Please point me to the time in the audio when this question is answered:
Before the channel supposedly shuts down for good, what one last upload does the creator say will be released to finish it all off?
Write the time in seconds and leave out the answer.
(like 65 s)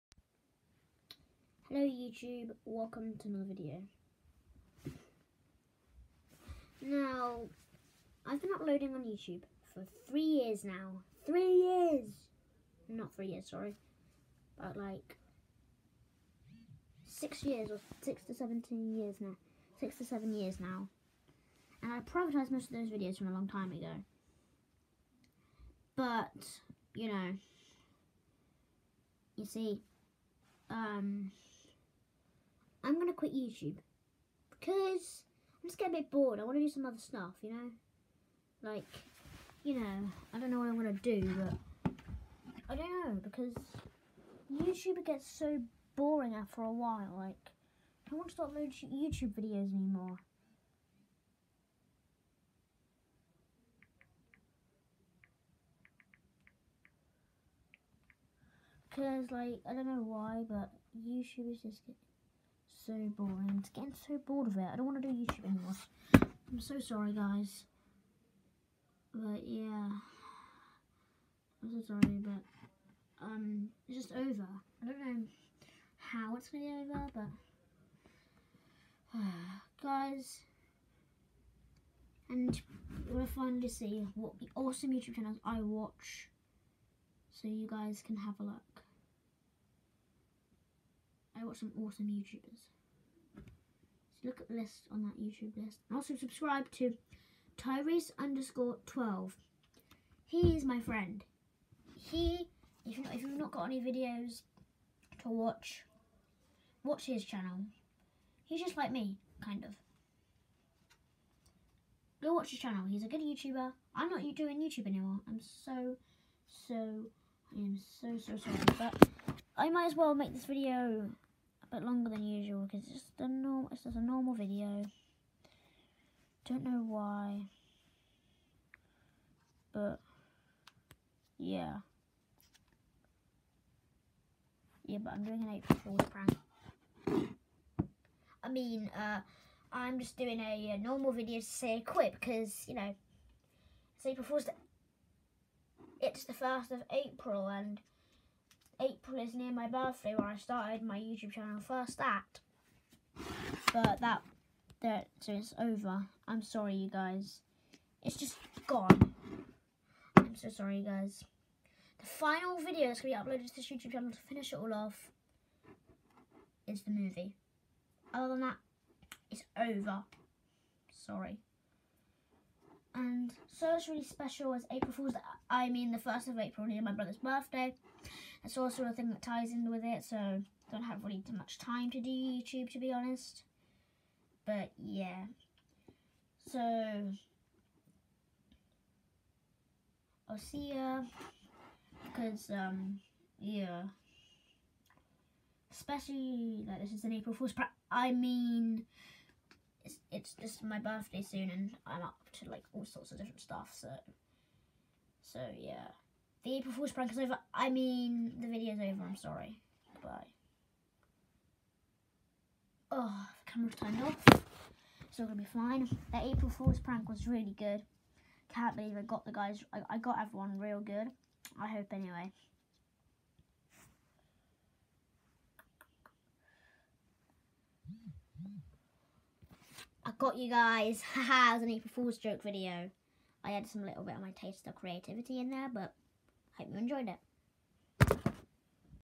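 166 s.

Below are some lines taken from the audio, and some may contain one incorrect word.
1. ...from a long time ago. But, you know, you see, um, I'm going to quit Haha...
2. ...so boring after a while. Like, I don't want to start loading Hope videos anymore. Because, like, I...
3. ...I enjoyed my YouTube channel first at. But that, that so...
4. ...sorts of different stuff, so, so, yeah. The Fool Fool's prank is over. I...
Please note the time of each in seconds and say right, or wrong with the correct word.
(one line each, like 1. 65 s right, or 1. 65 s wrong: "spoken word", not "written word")
1. 23 s wrong: "YouTube", not "Haha"
2. 45 s wrong: "YouTube", not "Hope"
3. 150 s wrong: "started", not "enjoyed"
4. 202 s wrong: "April", not "Fool".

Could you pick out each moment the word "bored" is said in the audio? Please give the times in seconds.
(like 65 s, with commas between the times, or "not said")
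36 s, 64 s.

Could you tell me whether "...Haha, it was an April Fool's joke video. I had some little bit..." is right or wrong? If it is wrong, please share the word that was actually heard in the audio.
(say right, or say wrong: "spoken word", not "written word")
right.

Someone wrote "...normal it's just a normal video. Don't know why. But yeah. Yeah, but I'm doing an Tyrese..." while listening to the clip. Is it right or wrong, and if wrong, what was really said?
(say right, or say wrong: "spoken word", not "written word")
wrong: "April", not "Tyrese".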